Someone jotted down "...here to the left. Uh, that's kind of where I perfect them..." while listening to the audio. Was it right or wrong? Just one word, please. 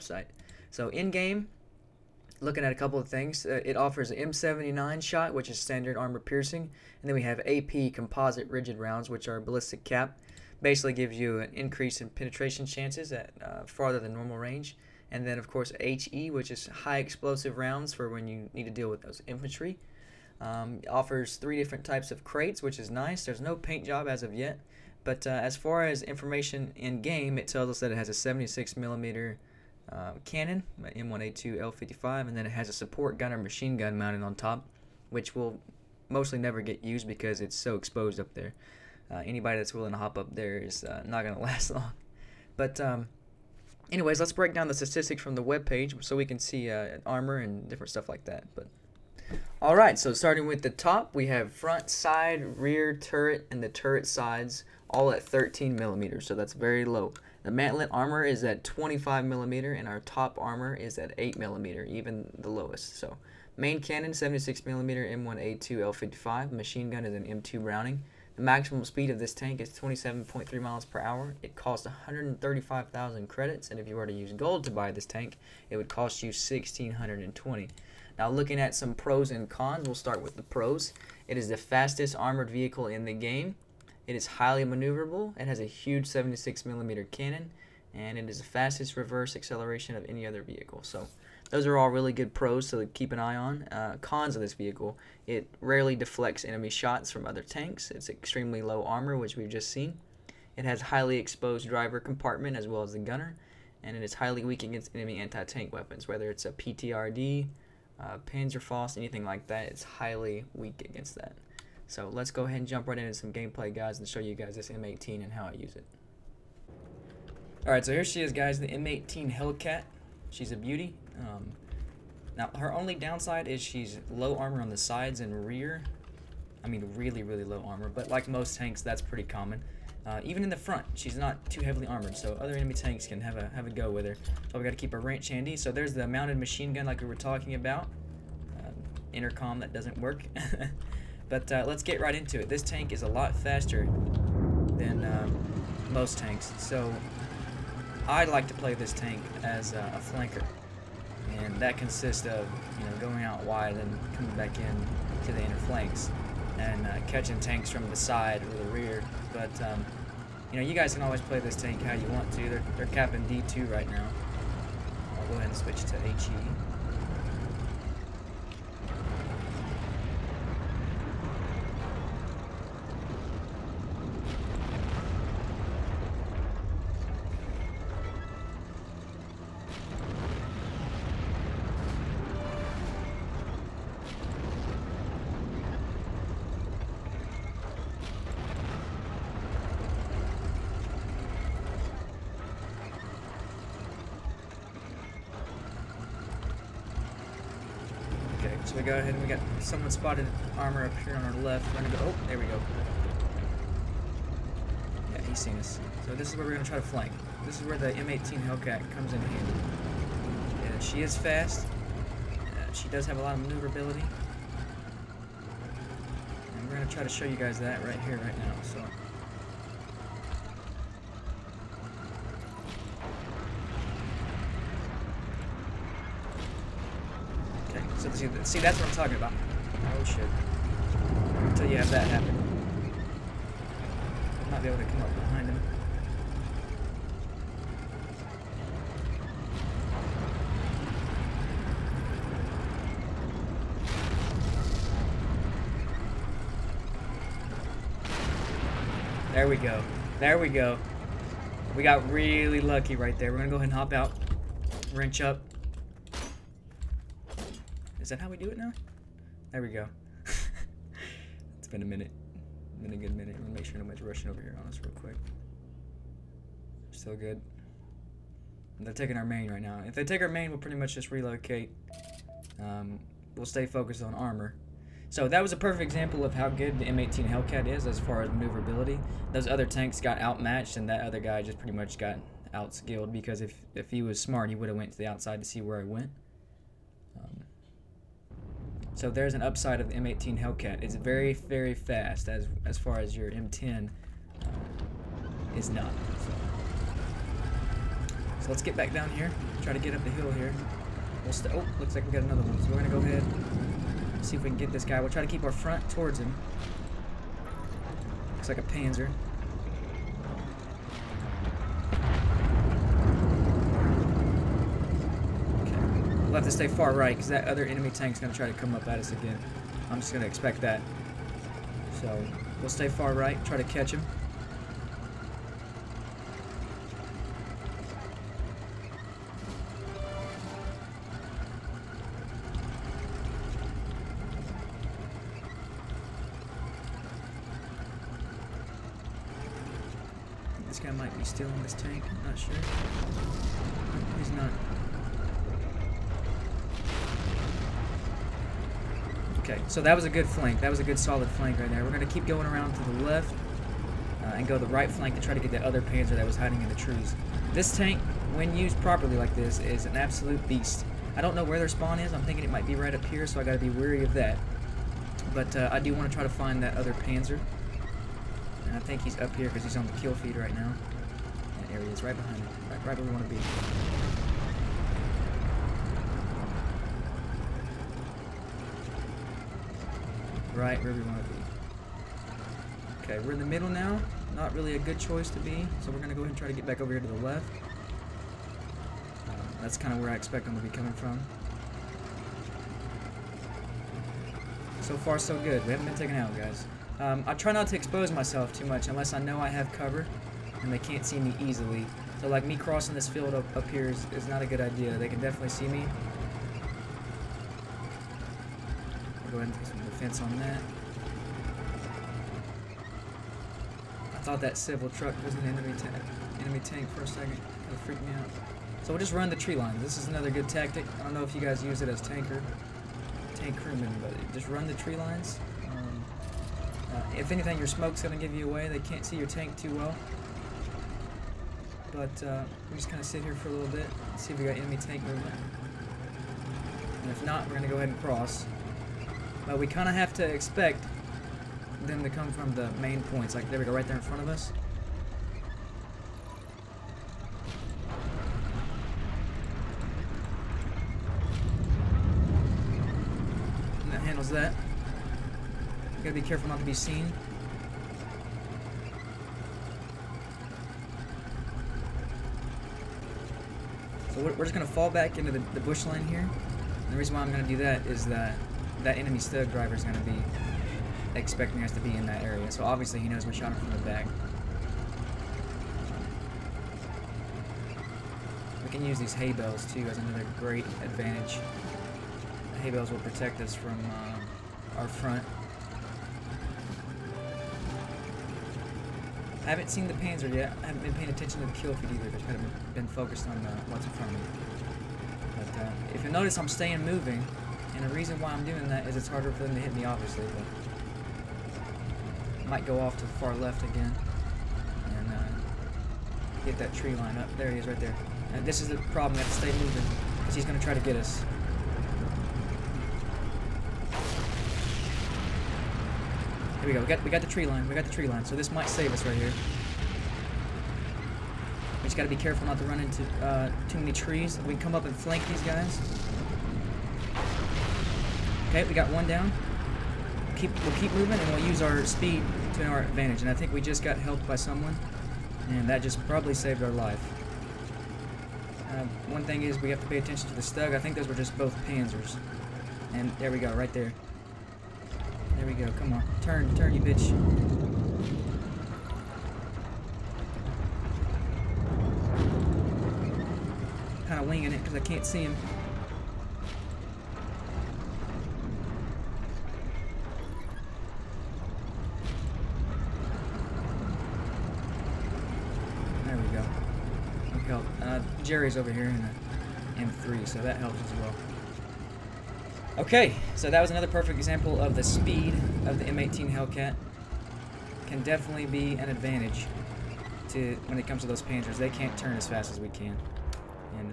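wrong.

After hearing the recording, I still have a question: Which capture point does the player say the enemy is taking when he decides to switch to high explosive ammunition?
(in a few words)
D2.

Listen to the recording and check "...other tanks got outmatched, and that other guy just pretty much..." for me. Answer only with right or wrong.
right.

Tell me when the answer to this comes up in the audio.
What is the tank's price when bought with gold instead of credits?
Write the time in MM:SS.
01:16.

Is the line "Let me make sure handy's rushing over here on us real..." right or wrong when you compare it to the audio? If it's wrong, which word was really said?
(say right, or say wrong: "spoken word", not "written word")
wrong: "nobody", not "handy".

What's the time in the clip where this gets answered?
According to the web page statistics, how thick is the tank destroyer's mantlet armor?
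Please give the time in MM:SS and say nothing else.
00:58.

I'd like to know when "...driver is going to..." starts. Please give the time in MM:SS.
07:49.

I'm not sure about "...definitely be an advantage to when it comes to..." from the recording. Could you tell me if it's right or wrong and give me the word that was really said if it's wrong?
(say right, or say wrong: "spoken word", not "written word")
right.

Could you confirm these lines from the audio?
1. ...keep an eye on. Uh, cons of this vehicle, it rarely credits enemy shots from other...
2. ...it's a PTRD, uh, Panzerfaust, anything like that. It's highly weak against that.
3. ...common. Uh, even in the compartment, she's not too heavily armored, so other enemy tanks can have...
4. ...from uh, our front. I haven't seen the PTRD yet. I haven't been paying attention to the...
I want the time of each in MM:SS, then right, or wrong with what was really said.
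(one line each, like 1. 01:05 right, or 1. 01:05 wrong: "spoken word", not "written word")
1. 01:32 wrong: "deflects", not "credits"
2. 01:46 right
3. 02:09 wrong: "front", not "compartment"
4. 08:03 wrong: "Panzer", not "PTRD".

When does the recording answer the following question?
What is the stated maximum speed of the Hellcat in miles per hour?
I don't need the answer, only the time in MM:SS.
01:09.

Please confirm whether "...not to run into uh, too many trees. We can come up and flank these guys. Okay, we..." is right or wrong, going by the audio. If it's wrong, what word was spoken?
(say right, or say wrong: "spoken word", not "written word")
right.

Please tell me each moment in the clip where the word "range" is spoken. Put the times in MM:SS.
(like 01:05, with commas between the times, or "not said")
00:14, 02:14.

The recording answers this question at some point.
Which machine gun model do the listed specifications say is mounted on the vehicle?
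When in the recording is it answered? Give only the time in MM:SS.
01:07.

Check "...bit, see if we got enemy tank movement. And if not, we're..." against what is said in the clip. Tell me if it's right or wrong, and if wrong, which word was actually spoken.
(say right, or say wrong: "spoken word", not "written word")
right.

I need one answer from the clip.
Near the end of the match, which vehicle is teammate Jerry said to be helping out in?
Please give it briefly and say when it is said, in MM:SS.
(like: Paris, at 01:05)
M3, at 09:29.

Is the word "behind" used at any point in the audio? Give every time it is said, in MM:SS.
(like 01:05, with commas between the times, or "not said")
03:55, 06:12.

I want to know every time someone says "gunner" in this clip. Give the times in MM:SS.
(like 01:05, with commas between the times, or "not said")
00:33, 01:42.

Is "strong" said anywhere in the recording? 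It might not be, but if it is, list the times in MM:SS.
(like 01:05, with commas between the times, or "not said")
not said.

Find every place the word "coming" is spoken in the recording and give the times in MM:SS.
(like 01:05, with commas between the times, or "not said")
02:34, 06:30.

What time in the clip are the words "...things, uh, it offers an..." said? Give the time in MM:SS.
00:03.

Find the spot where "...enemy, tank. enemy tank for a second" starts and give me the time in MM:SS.
06:55.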